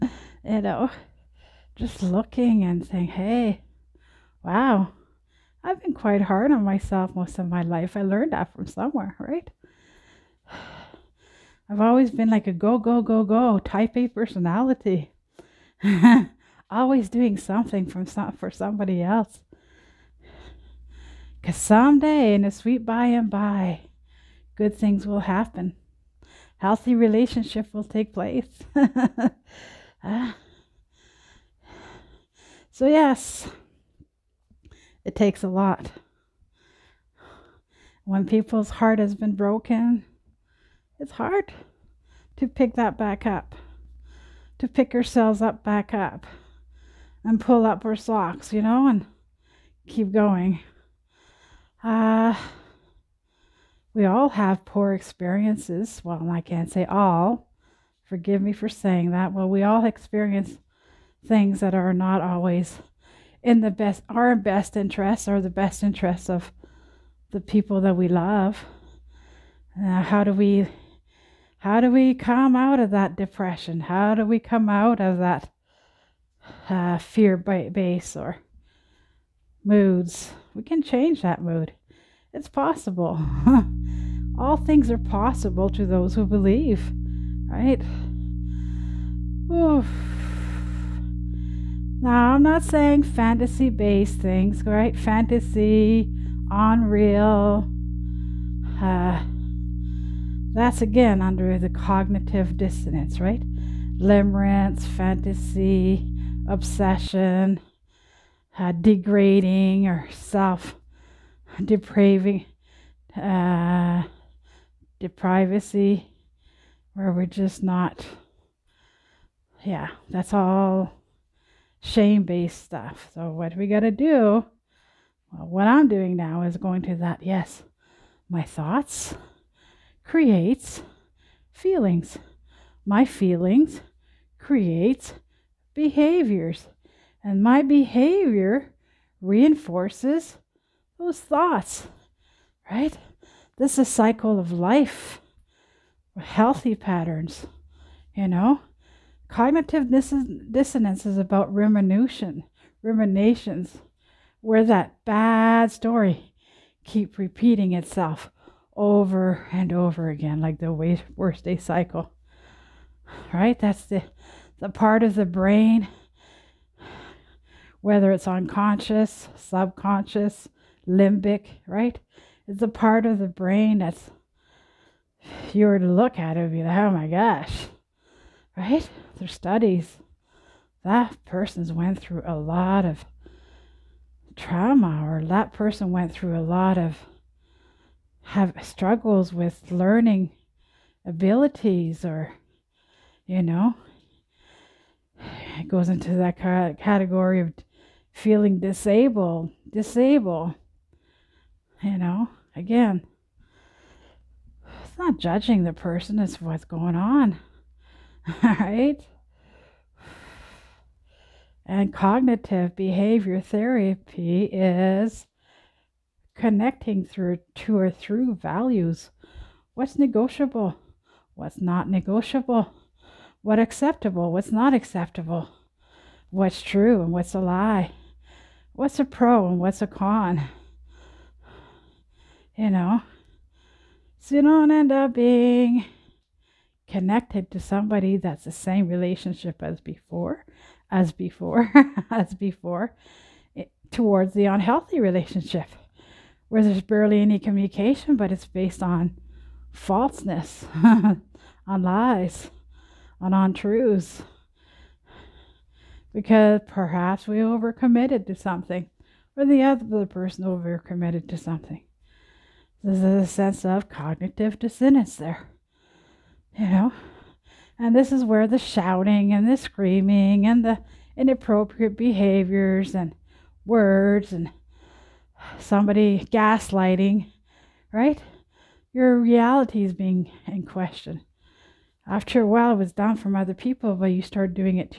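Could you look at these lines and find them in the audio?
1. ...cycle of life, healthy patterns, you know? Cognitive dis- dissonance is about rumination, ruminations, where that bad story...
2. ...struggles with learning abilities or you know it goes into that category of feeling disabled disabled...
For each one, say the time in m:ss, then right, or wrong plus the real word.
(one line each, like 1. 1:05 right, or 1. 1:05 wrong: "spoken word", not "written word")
1. 2:23 right
2. 3:08 right.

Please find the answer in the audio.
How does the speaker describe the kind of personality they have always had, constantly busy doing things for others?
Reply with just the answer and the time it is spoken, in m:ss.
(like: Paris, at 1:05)
Type A, at 0:13.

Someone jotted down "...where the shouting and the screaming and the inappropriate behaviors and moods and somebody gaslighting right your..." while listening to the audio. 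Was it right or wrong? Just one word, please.
wrong.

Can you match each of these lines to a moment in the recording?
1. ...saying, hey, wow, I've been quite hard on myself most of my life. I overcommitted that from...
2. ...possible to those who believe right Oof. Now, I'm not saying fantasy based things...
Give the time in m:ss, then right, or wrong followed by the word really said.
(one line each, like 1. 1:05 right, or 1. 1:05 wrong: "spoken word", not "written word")
1. 0:02 wrong: "learned", not "overcommitted"
2. 1:24 right.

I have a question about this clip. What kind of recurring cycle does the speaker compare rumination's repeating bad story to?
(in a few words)
Worst day cycle.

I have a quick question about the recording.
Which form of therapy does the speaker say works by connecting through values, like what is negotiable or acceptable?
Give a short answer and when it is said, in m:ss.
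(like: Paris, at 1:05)
Cognitive behavior therapy, at 3:31.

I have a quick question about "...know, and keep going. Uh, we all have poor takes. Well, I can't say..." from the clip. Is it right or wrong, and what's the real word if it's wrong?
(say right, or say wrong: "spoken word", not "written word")
wrong: "experiences", not "takes".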